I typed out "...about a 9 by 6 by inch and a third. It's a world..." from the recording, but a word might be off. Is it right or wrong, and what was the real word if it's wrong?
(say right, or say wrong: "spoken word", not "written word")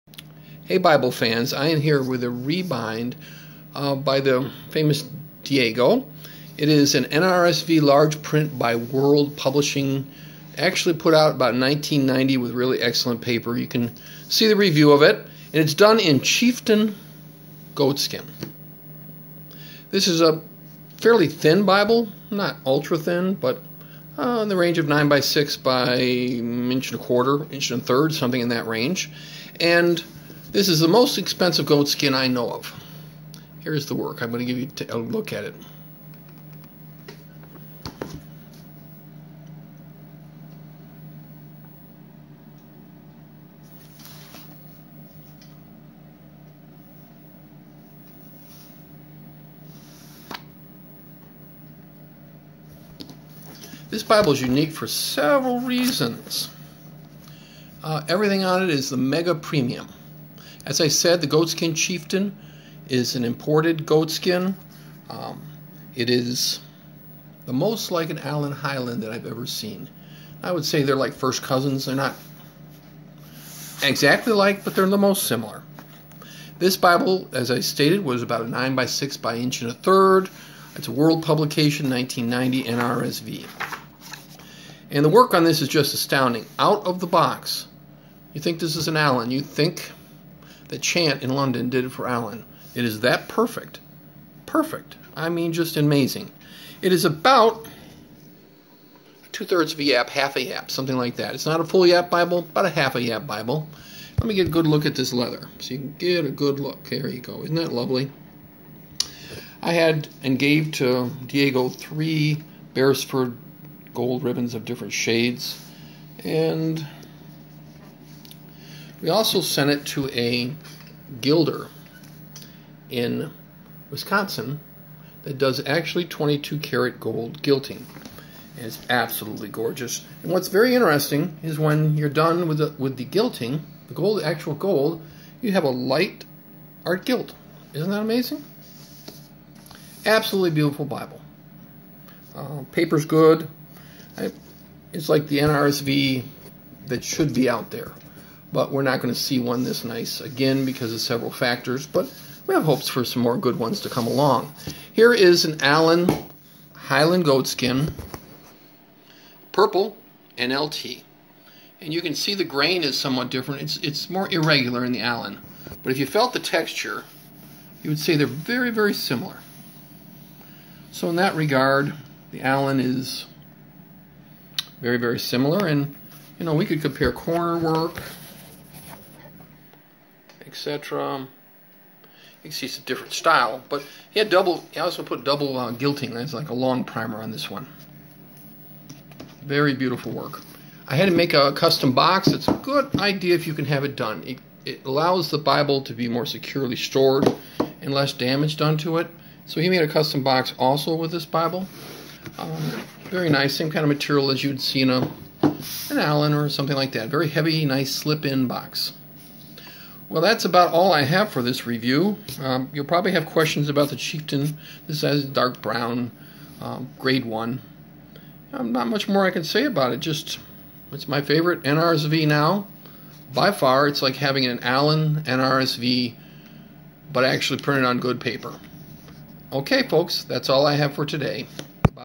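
right.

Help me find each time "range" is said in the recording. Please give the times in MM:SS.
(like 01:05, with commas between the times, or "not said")
00:24, 00:28.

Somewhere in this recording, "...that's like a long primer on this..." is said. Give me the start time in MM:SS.
03:06.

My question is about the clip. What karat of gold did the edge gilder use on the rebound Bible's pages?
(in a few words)
22 karat.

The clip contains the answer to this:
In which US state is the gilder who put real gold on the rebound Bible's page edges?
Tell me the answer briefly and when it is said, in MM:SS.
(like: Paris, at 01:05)
Wisconsin, at 02:03.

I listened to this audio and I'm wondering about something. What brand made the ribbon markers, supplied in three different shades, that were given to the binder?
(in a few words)
Beresford.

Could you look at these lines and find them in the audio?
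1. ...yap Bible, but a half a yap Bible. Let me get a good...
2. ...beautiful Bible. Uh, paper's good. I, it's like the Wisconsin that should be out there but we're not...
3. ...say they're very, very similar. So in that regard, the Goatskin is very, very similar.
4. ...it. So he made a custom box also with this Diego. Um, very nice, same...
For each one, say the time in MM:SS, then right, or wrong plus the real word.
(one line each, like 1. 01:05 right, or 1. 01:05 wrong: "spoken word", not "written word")
1. 01:41 right
2. 02:20 wrong: "NRSV", not "Wisconsin"
3. 02:47 wrong: "Allan", not "Goatskin"
4. 03:18 wrong: "Bible", not "Diego".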